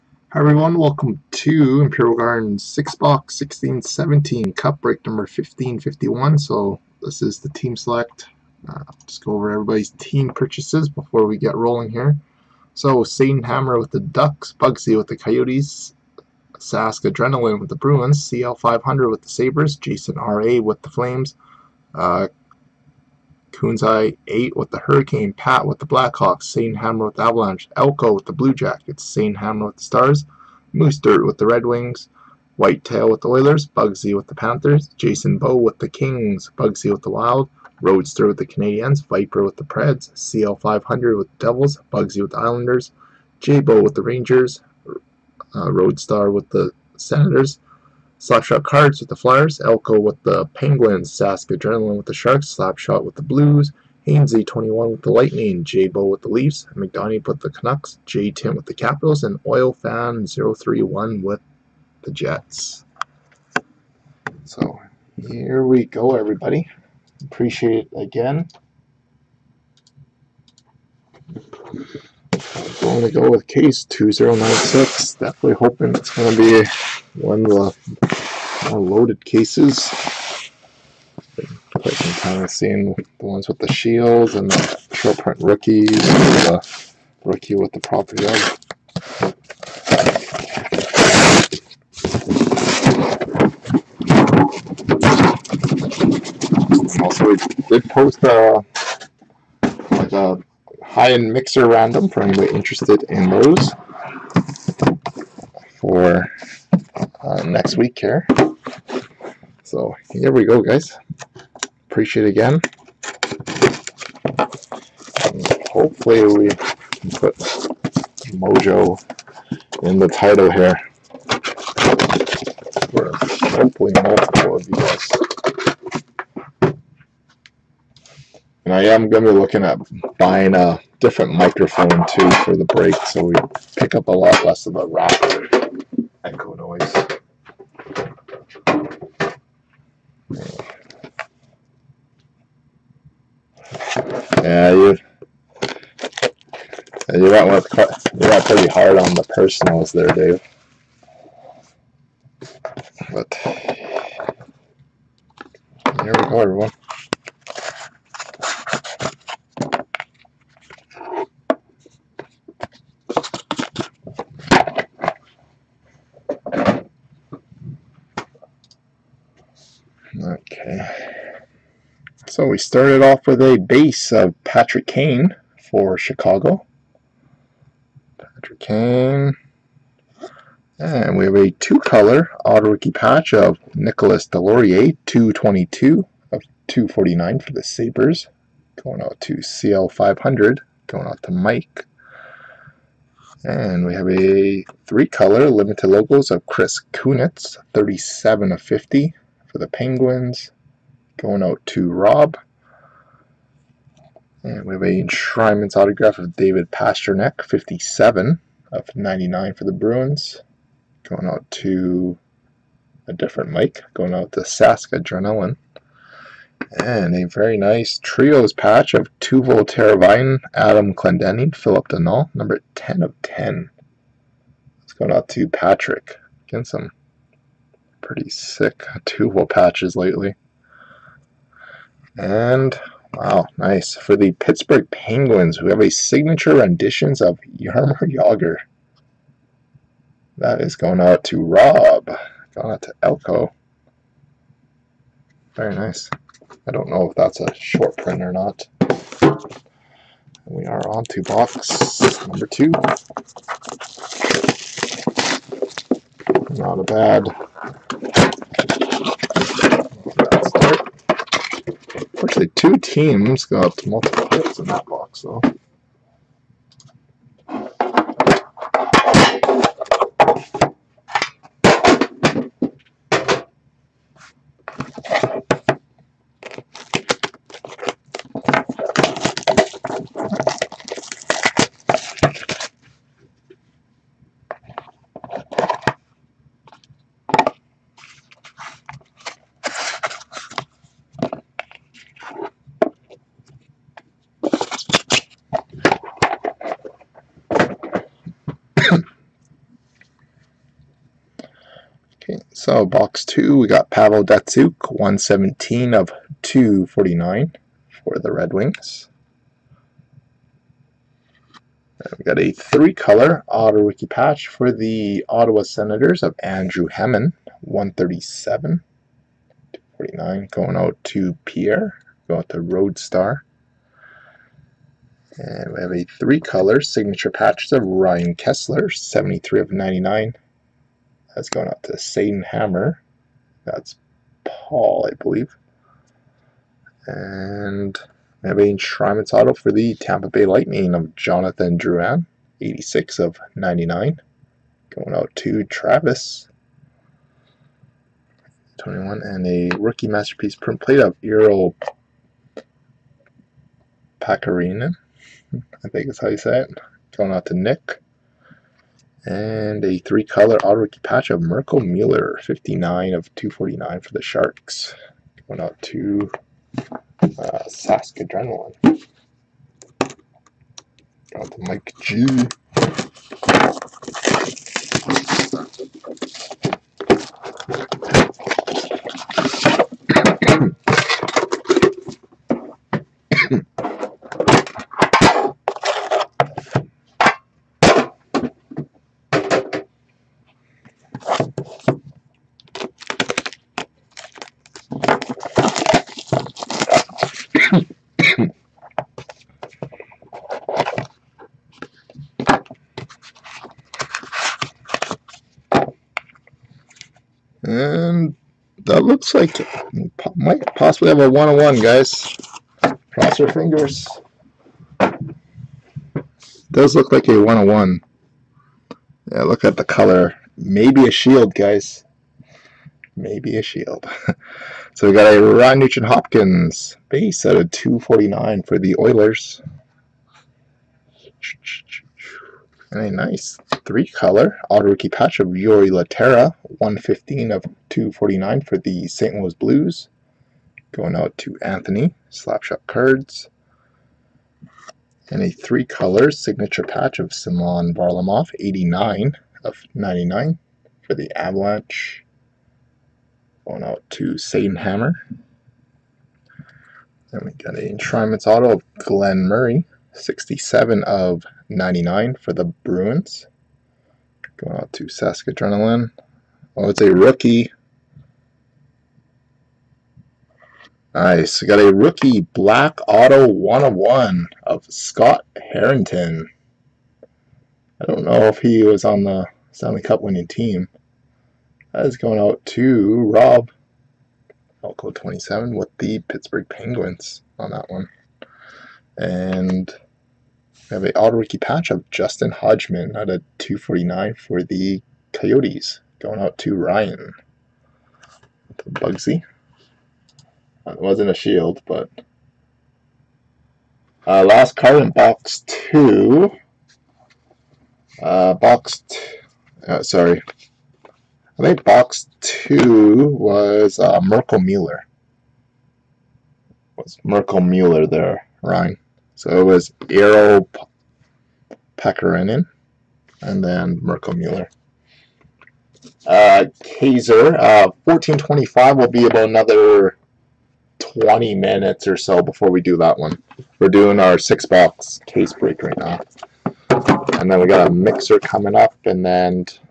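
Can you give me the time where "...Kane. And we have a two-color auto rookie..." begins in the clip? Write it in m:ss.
2:58.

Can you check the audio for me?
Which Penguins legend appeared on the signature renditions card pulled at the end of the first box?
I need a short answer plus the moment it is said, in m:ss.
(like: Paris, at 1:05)
Jaromir Jagr, at 3:57.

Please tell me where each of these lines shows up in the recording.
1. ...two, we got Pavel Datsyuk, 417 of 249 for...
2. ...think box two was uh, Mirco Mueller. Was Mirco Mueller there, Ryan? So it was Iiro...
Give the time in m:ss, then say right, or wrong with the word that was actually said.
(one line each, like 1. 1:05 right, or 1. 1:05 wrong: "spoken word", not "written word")
1. 5:03 wrong: "117", not "417"
2. 8:31 right.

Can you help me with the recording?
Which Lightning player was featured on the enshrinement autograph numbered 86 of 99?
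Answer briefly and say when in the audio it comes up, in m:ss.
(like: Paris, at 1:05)
Jonathan Drouin, at 5:41.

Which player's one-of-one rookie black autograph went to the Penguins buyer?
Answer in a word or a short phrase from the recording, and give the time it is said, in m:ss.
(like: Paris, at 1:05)
Scott Harrington, at 7:54.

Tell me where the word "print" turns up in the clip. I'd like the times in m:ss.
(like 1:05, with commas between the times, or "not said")
1:25, 4:07, 5:50.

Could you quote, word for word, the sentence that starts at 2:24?
Yeah, you you went with you went pretty hard on the personals there, Dave.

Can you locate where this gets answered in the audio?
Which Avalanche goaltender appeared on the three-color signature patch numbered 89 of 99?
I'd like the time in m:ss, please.
7:27.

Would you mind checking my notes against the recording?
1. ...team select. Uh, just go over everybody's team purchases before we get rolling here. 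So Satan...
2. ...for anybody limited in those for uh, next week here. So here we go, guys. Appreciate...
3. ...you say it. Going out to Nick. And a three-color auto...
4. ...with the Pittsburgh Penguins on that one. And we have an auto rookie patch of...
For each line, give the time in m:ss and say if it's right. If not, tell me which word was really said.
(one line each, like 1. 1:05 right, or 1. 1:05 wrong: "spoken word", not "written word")
1. 0:07 right
2. 1:42 wrong: "interested", not "limited"
3. 5:56 right
4. 8:05 right.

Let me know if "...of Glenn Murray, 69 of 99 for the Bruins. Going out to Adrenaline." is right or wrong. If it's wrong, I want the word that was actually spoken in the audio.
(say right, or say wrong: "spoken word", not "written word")
wrong: "67", not "69".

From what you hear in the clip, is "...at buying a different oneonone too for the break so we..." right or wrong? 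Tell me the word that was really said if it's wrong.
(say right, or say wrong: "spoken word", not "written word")
wrong: "microphone", not "oneonone".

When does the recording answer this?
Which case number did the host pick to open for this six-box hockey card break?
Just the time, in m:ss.
1:13.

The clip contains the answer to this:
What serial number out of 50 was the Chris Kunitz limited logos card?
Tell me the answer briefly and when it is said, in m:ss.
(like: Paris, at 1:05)
37, at 3:17.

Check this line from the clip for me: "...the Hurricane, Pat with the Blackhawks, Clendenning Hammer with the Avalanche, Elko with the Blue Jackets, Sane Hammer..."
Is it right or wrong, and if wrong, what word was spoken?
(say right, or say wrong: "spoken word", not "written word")
wrong: "Sane", not "Clendenning".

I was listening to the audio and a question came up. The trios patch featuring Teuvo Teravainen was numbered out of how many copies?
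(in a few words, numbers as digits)
10.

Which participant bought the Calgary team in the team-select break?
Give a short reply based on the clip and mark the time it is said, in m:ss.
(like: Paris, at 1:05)
Jason RA, at 0:19.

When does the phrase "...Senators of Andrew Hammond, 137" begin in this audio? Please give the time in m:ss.
5:15.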